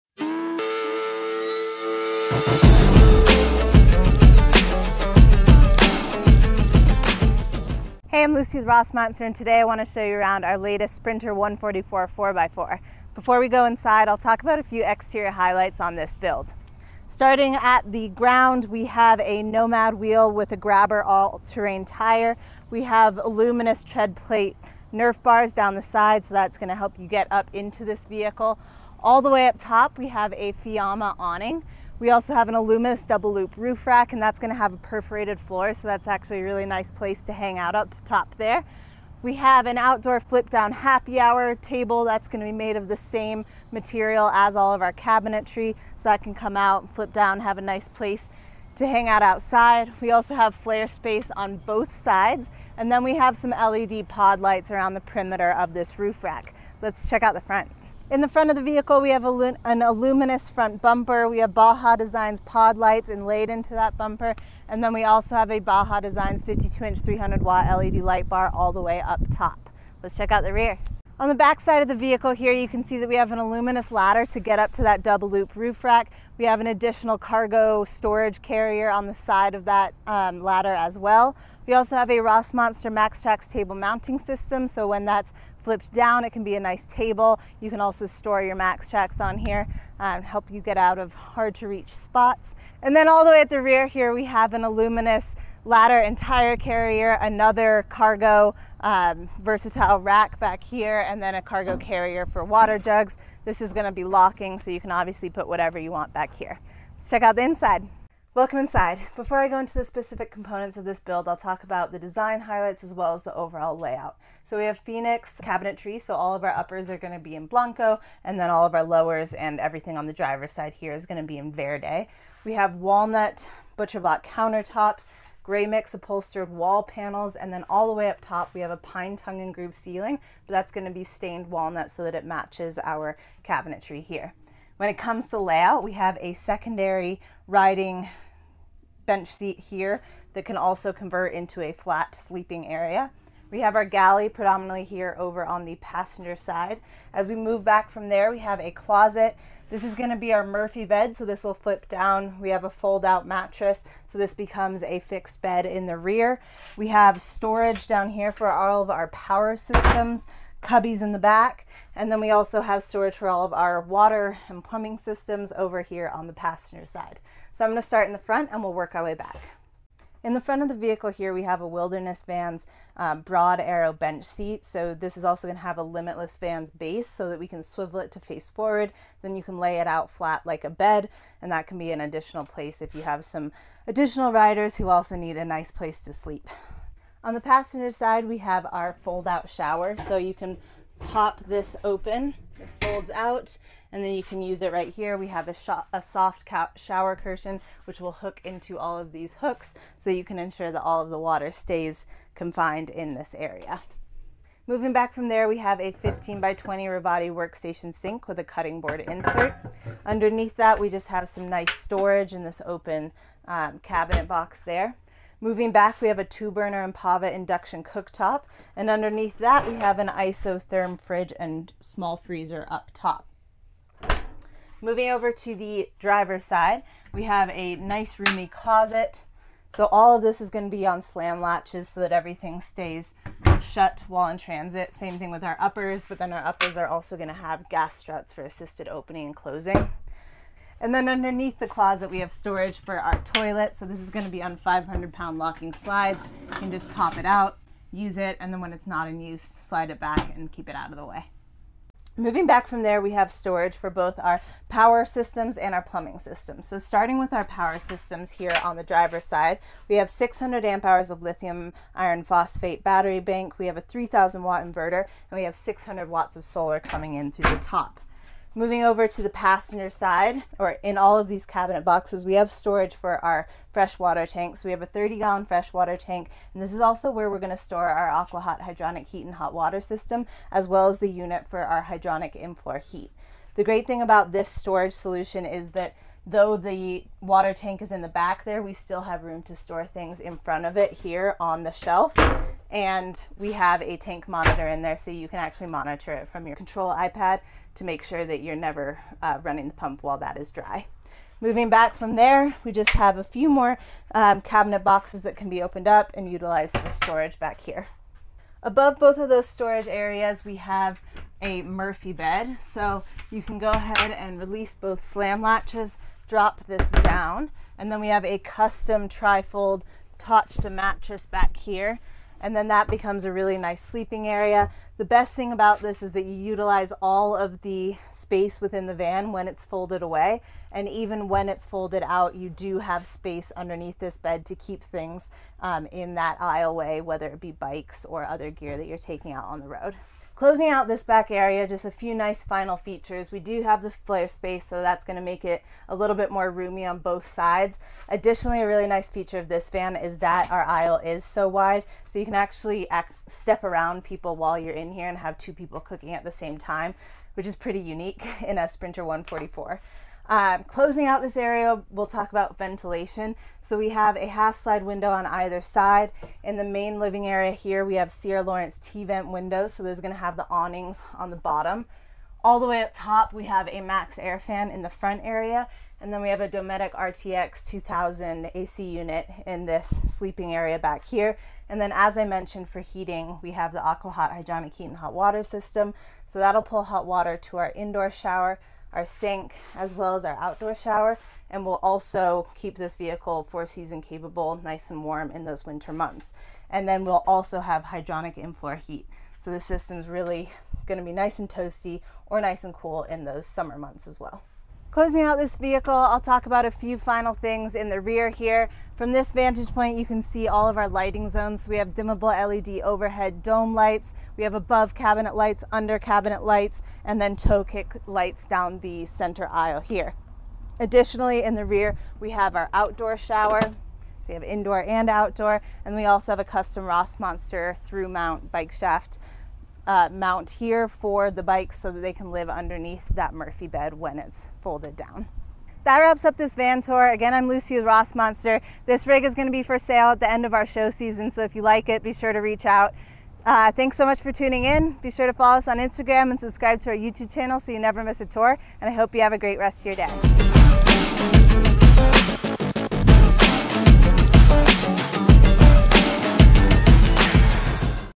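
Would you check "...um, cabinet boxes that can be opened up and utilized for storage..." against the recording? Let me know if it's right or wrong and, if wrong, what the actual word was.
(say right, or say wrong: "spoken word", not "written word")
right.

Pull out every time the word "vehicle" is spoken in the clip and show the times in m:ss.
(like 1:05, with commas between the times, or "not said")
0:28, 0:58, 1:11, 2:50, 6:32, 6:45.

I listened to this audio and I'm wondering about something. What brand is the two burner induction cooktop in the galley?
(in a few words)
Empava.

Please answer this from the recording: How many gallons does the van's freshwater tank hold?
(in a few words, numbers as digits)
30.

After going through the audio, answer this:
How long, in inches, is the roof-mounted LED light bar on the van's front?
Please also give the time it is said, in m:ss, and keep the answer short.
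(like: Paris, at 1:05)
52, at 1:06.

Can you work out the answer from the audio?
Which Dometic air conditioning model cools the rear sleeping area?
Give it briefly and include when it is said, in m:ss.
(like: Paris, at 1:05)
RTX 2000, at 6:16.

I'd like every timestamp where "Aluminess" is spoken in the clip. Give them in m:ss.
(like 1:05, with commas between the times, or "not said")
0:23, 0:32, 0:59, 1:13, 1:34.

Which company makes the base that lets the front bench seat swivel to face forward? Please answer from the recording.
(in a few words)
Limitless Vans.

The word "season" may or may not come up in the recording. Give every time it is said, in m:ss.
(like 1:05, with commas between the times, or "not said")
6:33, 7:20.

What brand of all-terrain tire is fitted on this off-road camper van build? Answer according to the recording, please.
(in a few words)
Grabber.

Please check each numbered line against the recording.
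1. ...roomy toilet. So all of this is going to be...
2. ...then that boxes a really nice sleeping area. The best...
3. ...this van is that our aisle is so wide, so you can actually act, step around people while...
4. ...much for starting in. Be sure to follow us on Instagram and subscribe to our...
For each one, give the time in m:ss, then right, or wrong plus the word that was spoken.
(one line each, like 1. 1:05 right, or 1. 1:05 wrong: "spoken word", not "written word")
1. 3:48 wrong: "closet", not "toilet"
2. 5:22 wrong: "becomes", not "boxes"
3. 5:49 right
4. 7:24 wrong: "tuning", not "starting".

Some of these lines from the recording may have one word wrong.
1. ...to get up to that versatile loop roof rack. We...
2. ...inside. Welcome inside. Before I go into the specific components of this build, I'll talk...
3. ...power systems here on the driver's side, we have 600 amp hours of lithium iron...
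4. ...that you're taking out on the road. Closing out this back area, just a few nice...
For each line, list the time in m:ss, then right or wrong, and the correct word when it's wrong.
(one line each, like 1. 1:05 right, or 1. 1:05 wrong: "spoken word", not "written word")
1. 1:14 wrong: "double", not "versatile"
2. 1:47 right
3. 4:17 right
4. 5:38 right.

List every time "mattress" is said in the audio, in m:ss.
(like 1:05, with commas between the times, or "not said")
2:33, 5:20.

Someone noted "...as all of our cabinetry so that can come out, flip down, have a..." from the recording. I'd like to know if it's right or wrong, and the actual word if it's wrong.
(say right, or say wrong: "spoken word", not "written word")
right.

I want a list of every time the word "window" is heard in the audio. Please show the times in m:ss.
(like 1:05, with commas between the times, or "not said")
6:04, 6:09.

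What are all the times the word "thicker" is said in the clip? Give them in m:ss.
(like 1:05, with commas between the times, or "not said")
not said.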